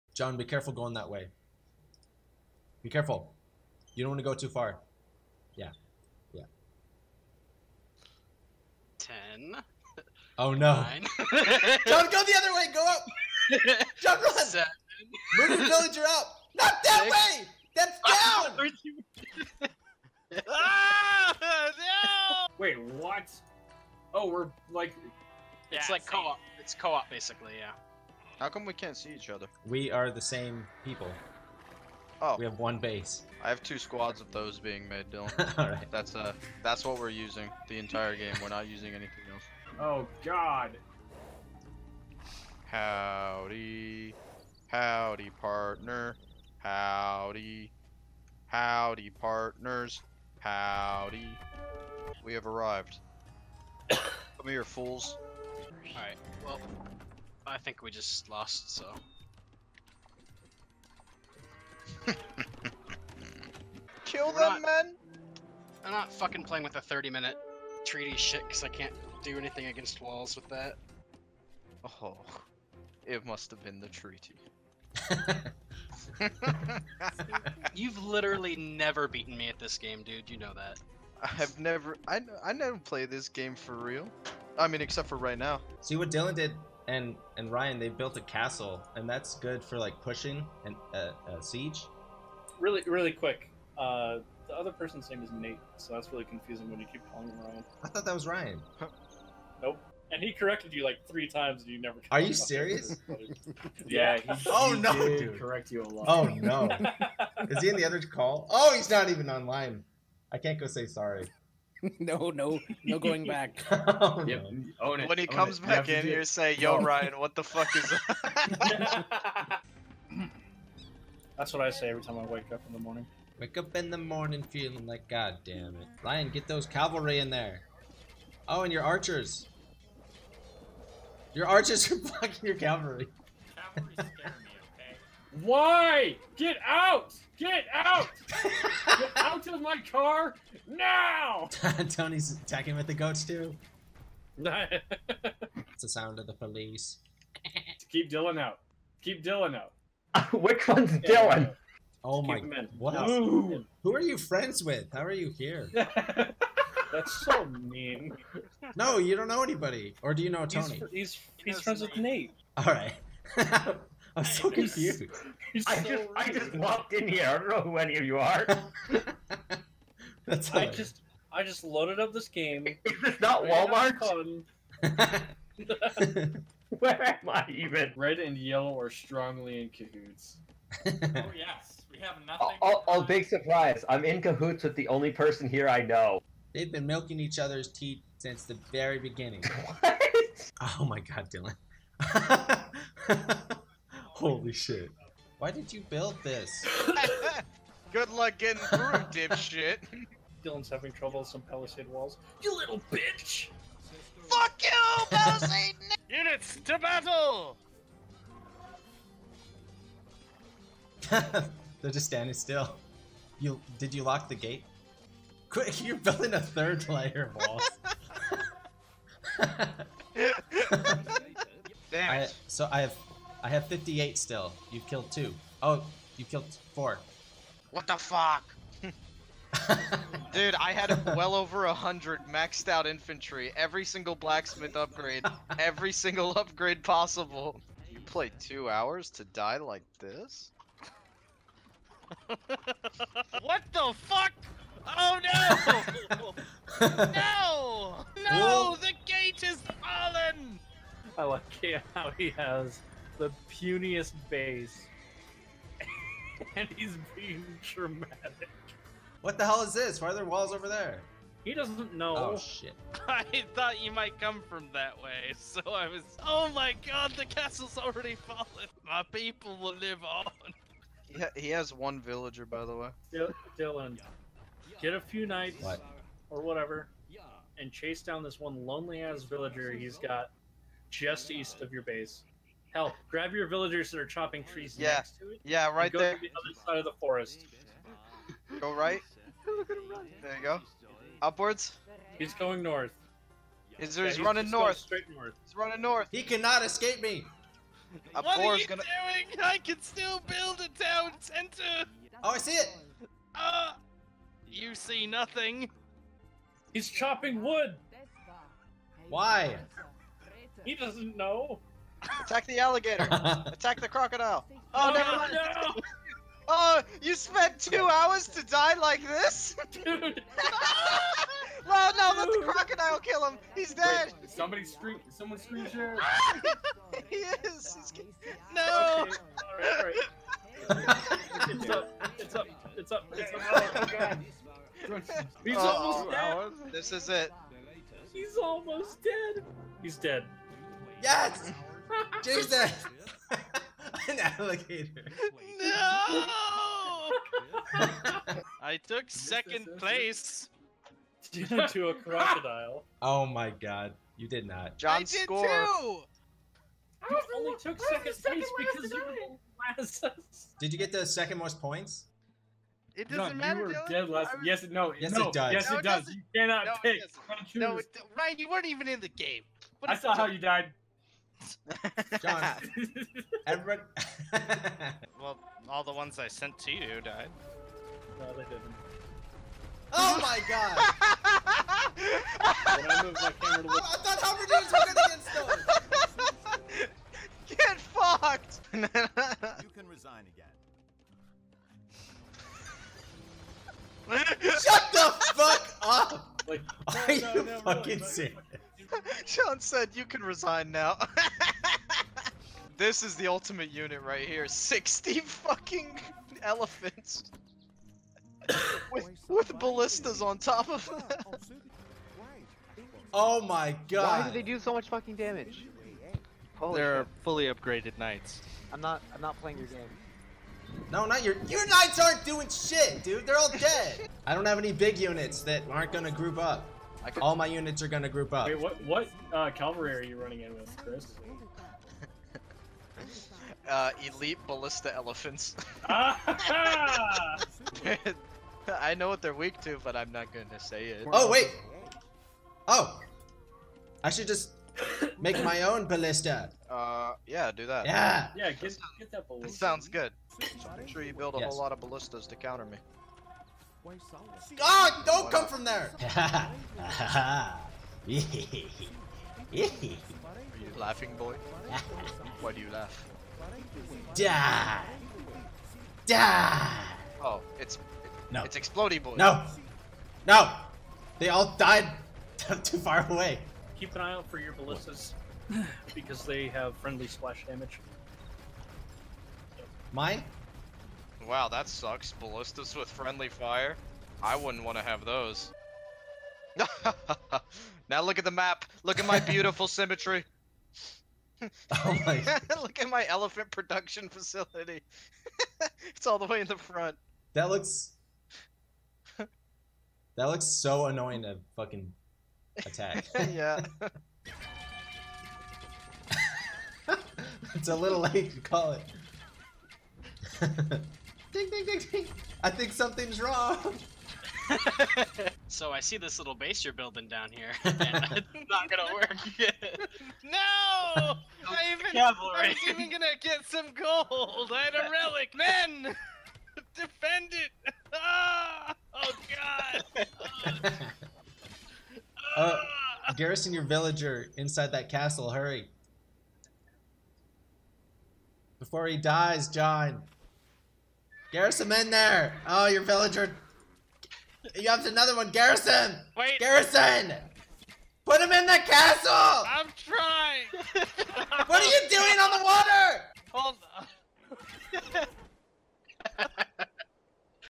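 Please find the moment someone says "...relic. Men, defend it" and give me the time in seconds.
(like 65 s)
524 s.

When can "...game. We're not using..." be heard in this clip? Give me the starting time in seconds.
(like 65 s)
38 s.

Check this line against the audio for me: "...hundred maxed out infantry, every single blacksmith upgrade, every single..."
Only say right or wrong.
right.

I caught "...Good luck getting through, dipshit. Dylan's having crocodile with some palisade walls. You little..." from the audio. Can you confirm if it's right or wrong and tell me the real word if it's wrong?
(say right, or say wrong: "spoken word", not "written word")
wrong: "trouble", not "crocodile".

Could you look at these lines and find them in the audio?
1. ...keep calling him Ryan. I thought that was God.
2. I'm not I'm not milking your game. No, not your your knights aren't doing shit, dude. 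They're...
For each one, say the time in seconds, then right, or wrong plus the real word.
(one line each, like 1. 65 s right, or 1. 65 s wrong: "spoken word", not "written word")
1. 96 s wrong: "Ryan", not "God"
2. 418 s wrong: "playing", not "milking".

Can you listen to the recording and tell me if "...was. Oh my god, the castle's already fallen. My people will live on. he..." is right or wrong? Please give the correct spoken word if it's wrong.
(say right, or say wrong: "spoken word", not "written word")
right.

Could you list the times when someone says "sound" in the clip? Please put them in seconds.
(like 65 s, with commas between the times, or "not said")
145 s, 449 s.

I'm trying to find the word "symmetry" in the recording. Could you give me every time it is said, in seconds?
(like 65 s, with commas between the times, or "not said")
489 s.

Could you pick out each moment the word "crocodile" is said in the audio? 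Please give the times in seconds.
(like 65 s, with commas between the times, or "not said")
313 s, 322 s, 351 s.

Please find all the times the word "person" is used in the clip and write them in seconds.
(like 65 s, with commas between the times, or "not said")
94 s, 185 s.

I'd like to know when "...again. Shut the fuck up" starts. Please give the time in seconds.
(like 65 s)
394 s.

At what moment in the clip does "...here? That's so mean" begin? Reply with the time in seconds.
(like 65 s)
155 s.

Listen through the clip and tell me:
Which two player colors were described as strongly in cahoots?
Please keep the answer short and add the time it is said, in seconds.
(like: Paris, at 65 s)
Red and yellow, at 177 s.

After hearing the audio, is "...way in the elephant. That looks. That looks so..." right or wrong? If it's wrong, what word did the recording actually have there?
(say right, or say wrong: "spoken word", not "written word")
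wrong: "front", not "elephant".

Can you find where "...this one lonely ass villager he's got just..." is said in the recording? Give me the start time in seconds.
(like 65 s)
278 s.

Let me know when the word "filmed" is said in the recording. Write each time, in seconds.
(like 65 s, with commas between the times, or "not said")
not said.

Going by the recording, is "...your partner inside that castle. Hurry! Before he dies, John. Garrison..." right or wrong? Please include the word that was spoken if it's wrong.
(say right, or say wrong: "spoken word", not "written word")
wrong: "villager", not "partner".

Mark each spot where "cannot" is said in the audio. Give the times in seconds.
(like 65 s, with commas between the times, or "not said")
296 s, 366 s.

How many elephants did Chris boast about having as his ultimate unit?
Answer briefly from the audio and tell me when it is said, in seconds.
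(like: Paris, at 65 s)
60, at 404 s.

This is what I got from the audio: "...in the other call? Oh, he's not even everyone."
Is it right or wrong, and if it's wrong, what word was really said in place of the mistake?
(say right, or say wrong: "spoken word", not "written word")
wrong: "online", not "everyone".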